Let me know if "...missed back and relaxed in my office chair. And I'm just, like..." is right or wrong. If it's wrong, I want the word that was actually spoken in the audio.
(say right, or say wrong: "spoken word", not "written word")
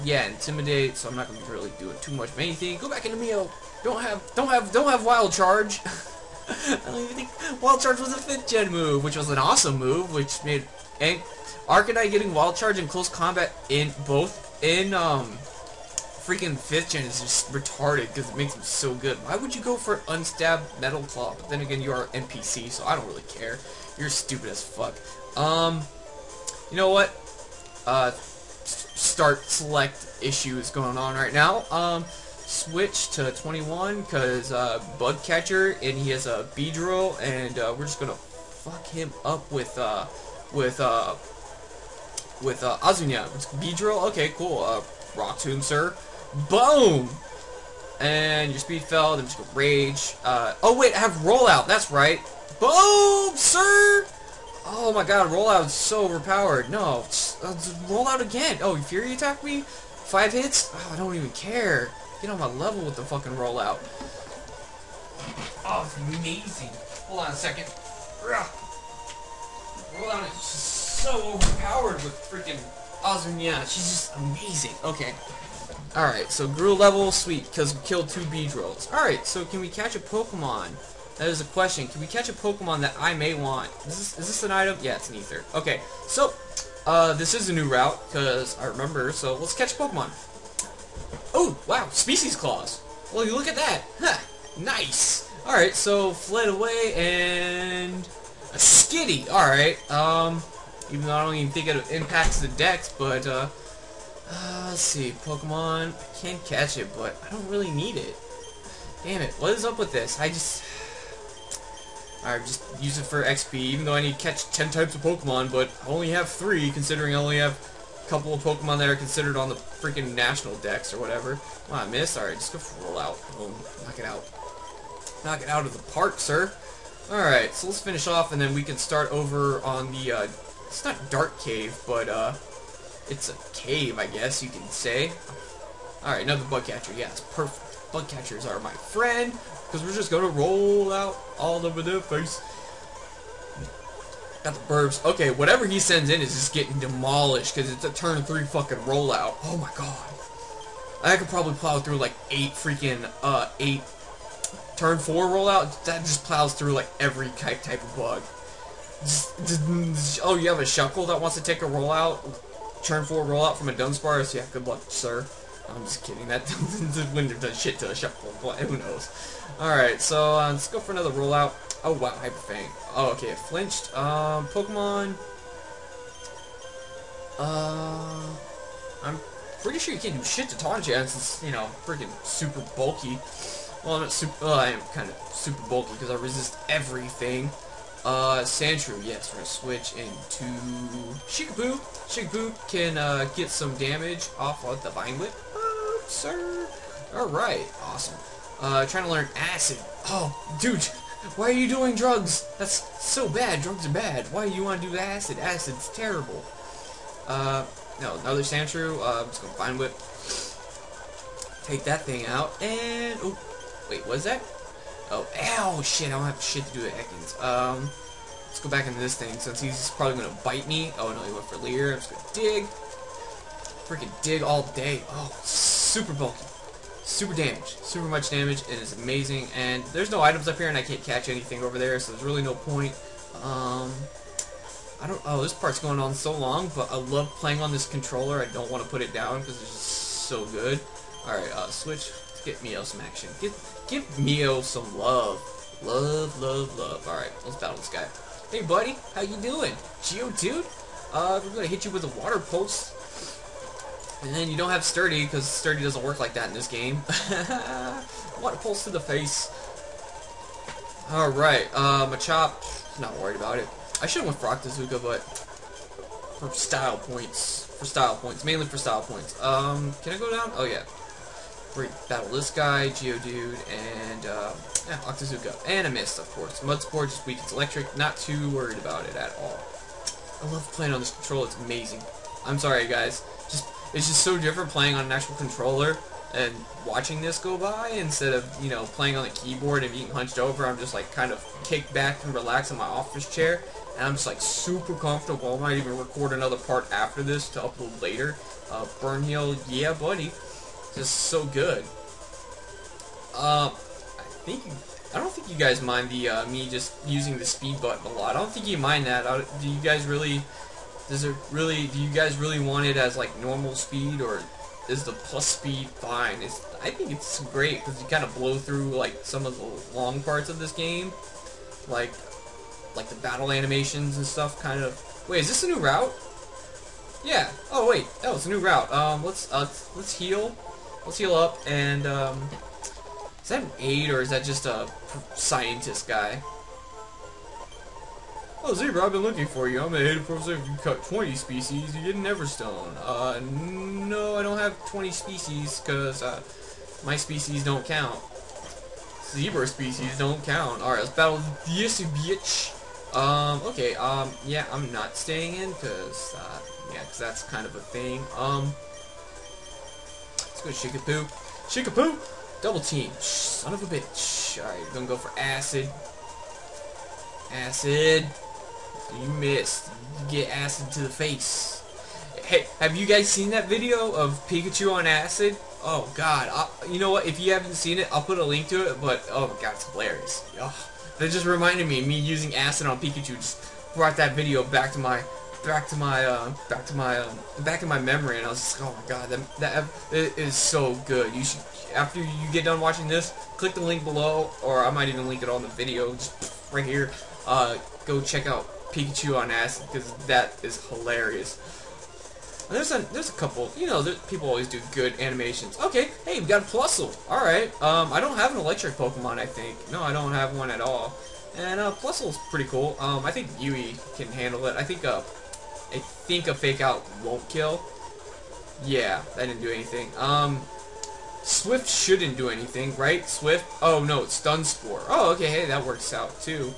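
wrong: "kicked", not "missed".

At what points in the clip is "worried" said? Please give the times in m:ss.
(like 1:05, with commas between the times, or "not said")
4:23, 4:38.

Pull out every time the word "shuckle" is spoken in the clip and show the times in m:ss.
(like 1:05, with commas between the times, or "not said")
2:40, 2:47.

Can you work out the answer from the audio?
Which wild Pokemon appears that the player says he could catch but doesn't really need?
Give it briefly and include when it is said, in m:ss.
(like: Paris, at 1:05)
Skitty, at 1:38.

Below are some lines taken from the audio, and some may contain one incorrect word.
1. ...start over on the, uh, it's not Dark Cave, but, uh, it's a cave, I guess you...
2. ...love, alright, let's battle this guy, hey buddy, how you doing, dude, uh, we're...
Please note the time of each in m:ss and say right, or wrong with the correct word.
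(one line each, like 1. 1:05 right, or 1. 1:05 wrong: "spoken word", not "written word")
1. 2:08 right
2. 4:06 right.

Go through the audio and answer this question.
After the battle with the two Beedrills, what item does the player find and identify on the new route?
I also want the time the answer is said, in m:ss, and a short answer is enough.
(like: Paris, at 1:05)
Ether, at 1:24.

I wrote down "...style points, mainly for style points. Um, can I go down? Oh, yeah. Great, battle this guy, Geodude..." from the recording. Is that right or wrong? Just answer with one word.
right.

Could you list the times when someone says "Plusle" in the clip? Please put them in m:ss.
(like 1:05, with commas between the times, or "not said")
6:46, 6:51.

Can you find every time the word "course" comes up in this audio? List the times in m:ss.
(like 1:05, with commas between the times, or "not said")
4:36.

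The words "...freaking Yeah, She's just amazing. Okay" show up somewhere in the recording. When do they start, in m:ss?
1:12.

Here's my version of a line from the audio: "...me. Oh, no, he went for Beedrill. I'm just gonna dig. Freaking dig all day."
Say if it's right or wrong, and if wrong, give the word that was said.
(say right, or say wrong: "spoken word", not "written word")
wrong: "Leer", not "Beedrill".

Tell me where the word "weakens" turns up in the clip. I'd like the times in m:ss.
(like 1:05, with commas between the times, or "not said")
4:37.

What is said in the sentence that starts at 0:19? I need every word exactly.
Why would you go for unstabbed Metal Claw?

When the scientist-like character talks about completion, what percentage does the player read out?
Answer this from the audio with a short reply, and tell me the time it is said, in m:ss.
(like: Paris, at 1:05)
84%, at 5:39.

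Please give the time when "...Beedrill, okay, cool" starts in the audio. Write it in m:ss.
0:43.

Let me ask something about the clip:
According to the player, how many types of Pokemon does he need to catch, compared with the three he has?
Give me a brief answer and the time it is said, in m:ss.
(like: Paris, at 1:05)
10, at 1:53.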